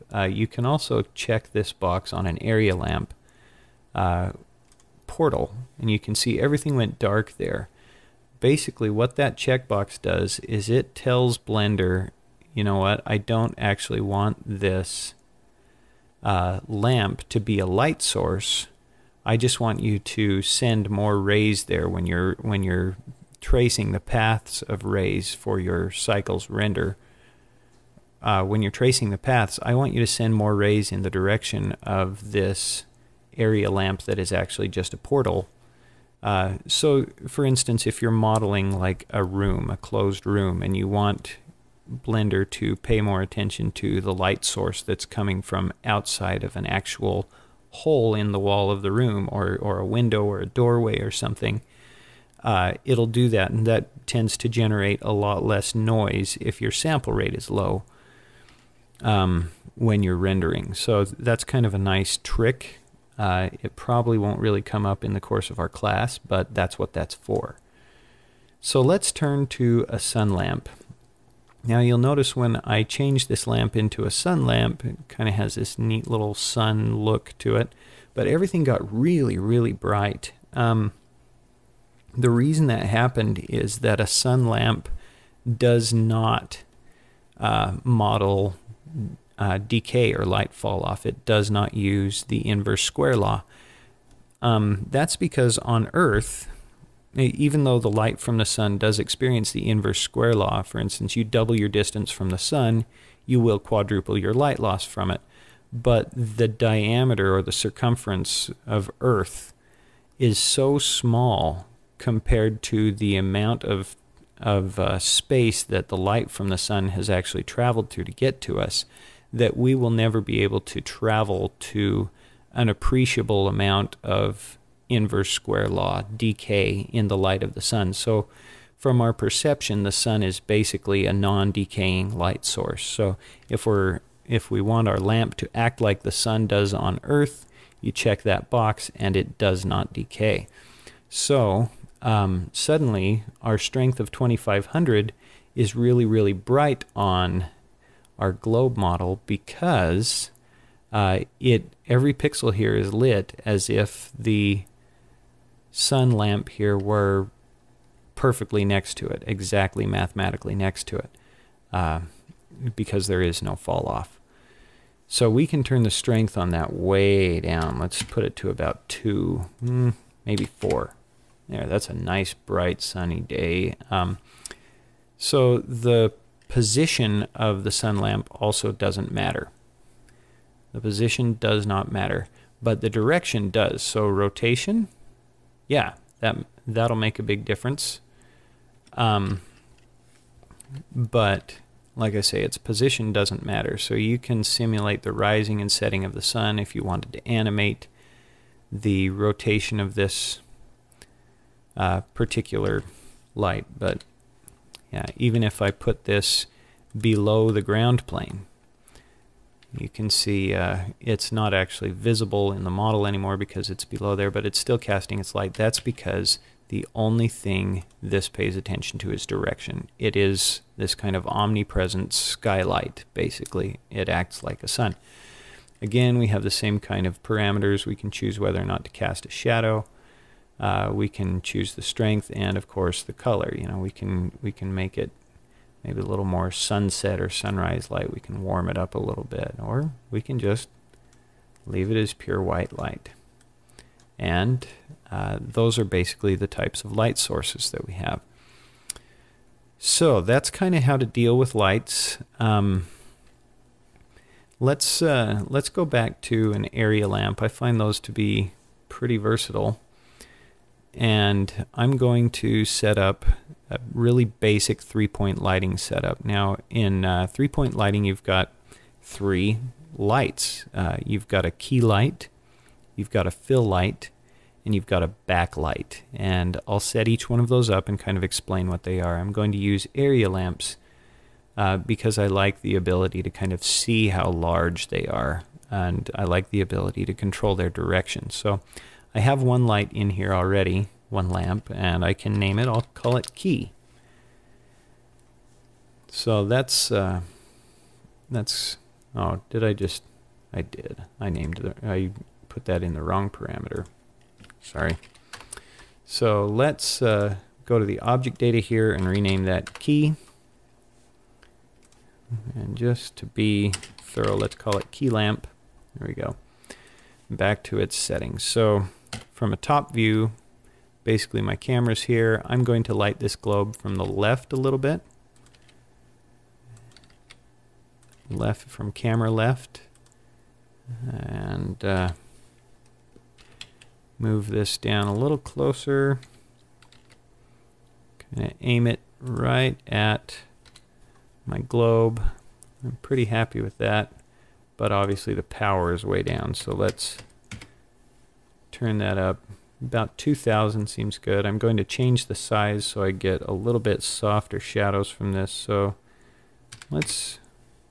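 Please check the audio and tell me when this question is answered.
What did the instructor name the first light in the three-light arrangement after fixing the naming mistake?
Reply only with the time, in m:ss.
5:14.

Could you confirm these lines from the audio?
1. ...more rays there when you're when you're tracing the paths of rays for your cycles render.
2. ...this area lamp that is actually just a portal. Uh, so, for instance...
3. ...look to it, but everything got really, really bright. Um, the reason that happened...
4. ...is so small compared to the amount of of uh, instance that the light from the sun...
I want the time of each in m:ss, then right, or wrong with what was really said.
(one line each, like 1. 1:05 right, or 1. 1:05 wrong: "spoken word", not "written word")
1. 0:20 right
2. 0:32 right
3. 1:16 right
4. 1:50 wrong: "space", not "instance".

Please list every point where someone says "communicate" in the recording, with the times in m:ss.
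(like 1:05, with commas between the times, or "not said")
not said.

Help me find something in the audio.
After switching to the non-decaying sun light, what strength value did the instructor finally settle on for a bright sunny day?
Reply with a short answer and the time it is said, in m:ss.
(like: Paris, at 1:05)
4, at 2:50.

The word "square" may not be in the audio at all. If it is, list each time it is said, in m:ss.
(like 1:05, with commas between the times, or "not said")
1:32, 1:40, 2:05.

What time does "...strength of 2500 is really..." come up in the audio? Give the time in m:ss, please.
2:23.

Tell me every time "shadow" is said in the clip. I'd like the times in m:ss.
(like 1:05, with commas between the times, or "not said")
3:49, 5:54.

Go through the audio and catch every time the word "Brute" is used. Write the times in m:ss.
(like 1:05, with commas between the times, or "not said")
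not said.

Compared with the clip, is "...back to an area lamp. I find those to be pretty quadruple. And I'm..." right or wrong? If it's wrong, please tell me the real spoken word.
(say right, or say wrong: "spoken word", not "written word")
wrong: "versatile", not "quadruple".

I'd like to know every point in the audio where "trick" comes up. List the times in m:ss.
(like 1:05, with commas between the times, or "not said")
1:02.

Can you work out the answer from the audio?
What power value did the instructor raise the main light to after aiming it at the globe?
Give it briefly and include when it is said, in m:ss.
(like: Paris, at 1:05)
2,000, at 5:50.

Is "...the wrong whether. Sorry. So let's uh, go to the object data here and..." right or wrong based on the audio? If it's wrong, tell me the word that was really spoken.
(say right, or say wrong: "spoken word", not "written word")
wrong: "parameter", not "whether".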